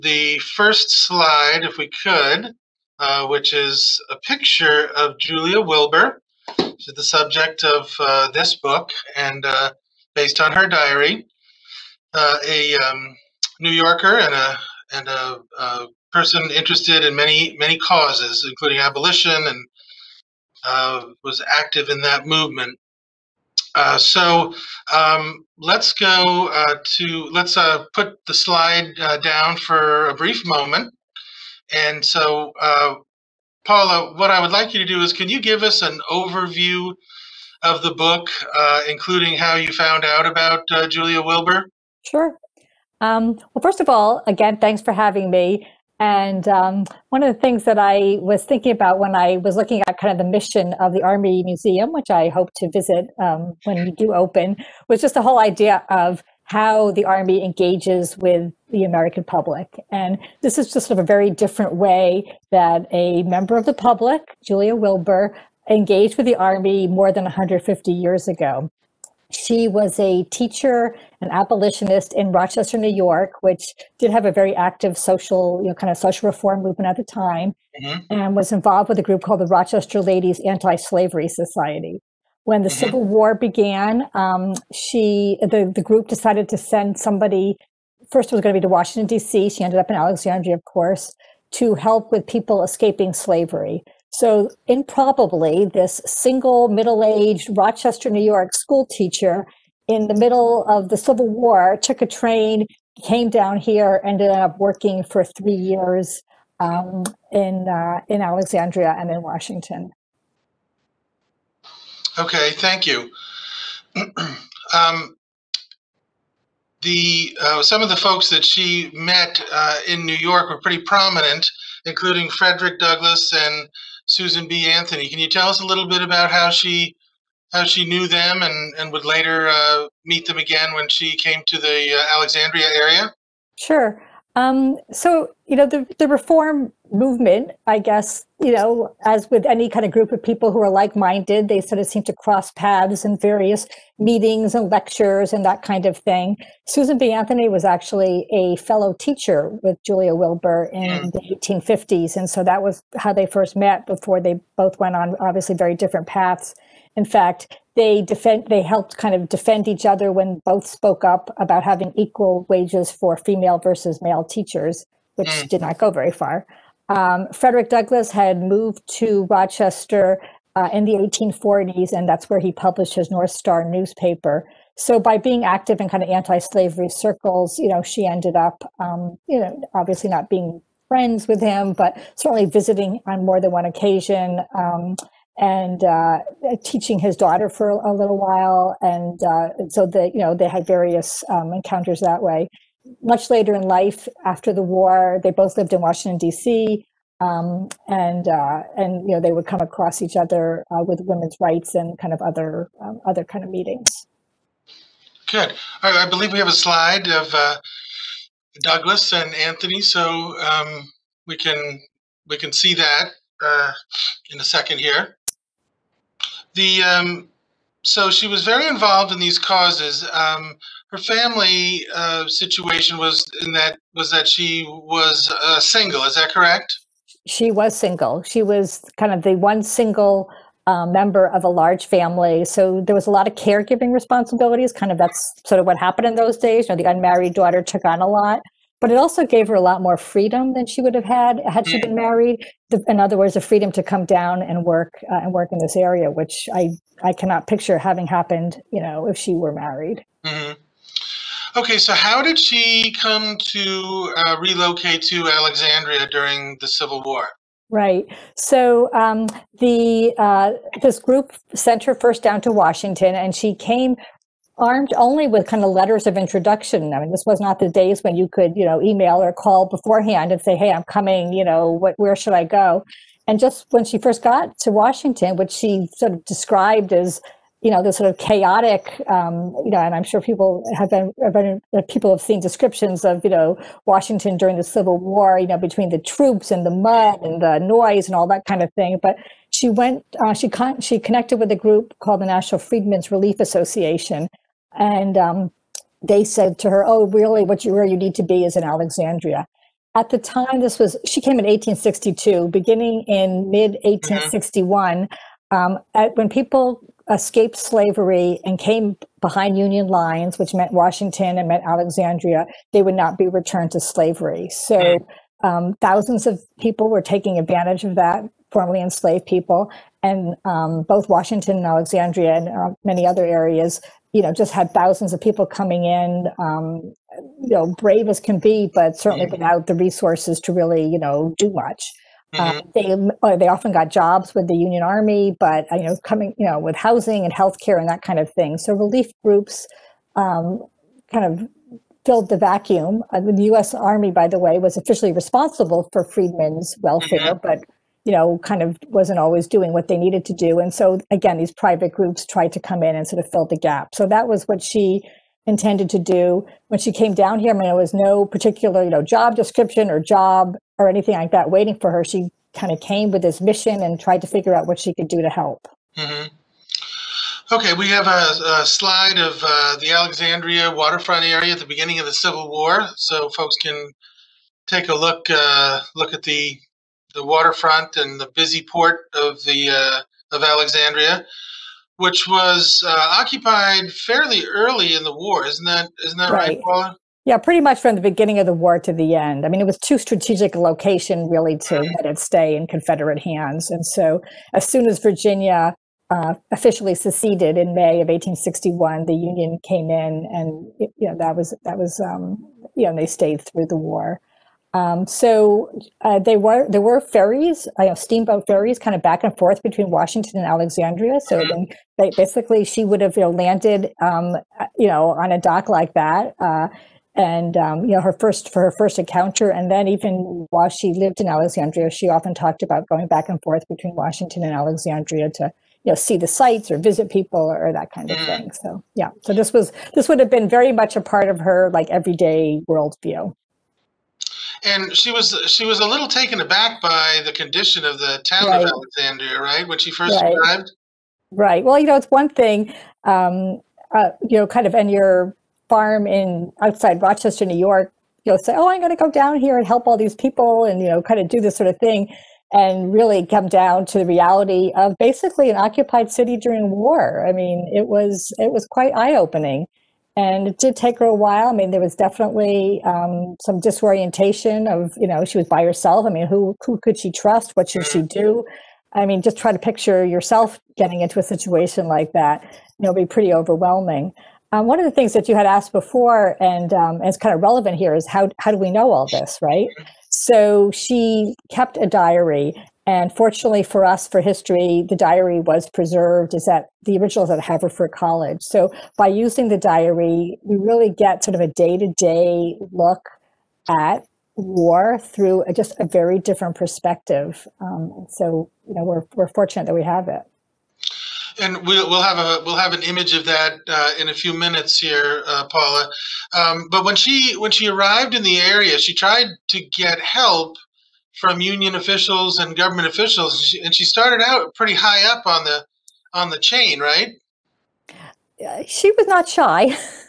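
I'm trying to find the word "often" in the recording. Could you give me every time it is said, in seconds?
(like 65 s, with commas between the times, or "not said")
333 s, 422 s.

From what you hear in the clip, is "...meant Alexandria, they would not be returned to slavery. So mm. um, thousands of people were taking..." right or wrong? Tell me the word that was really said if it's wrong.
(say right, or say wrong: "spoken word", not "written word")
right.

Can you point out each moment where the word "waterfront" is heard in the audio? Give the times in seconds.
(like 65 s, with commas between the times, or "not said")
370 s, 377 s.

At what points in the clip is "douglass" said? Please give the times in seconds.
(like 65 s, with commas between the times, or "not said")
122 s, 167 s, 208 s.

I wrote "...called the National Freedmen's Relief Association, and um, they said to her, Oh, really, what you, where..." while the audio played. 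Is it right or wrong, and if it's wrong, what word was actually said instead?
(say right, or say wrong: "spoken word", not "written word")
right.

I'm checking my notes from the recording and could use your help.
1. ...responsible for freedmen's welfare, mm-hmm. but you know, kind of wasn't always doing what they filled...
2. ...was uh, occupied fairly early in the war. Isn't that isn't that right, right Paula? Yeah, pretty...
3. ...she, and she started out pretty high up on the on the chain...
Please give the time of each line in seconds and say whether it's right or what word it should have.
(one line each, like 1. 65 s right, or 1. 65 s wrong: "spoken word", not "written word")
1. 345 s wrong: "needed", not "filled"
2. 382 s right
3. 513 s right.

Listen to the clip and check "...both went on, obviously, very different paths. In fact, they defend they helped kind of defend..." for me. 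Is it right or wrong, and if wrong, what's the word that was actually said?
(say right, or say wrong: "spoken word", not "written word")
right.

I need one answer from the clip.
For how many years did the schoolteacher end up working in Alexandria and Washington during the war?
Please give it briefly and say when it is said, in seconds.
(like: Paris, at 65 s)
3, at 105 s.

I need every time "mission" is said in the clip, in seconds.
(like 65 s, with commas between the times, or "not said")
50 s, 363 s.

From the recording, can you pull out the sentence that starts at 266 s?
I mean, this was not the days when you could, you know, email or call beforehand and say, "Hey, I'm coming.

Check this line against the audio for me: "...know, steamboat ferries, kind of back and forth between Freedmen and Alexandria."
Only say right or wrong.
wrong.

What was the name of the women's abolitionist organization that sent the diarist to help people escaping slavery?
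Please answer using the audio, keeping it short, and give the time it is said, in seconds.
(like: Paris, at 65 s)
Rochester Ladies Anti Slavery Society, at 79 s.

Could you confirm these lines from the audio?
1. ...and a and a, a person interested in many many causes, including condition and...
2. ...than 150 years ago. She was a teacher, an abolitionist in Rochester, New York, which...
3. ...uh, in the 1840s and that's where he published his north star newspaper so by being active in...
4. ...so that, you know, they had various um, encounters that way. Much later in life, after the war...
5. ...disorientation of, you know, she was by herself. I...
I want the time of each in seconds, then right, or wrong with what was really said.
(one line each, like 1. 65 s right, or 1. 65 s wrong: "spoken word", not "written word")
1. 14 s wrong: "abolition", not "condition"
2. 67 s right
3. 170 s right
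4. 189 s right
5. 463 s right.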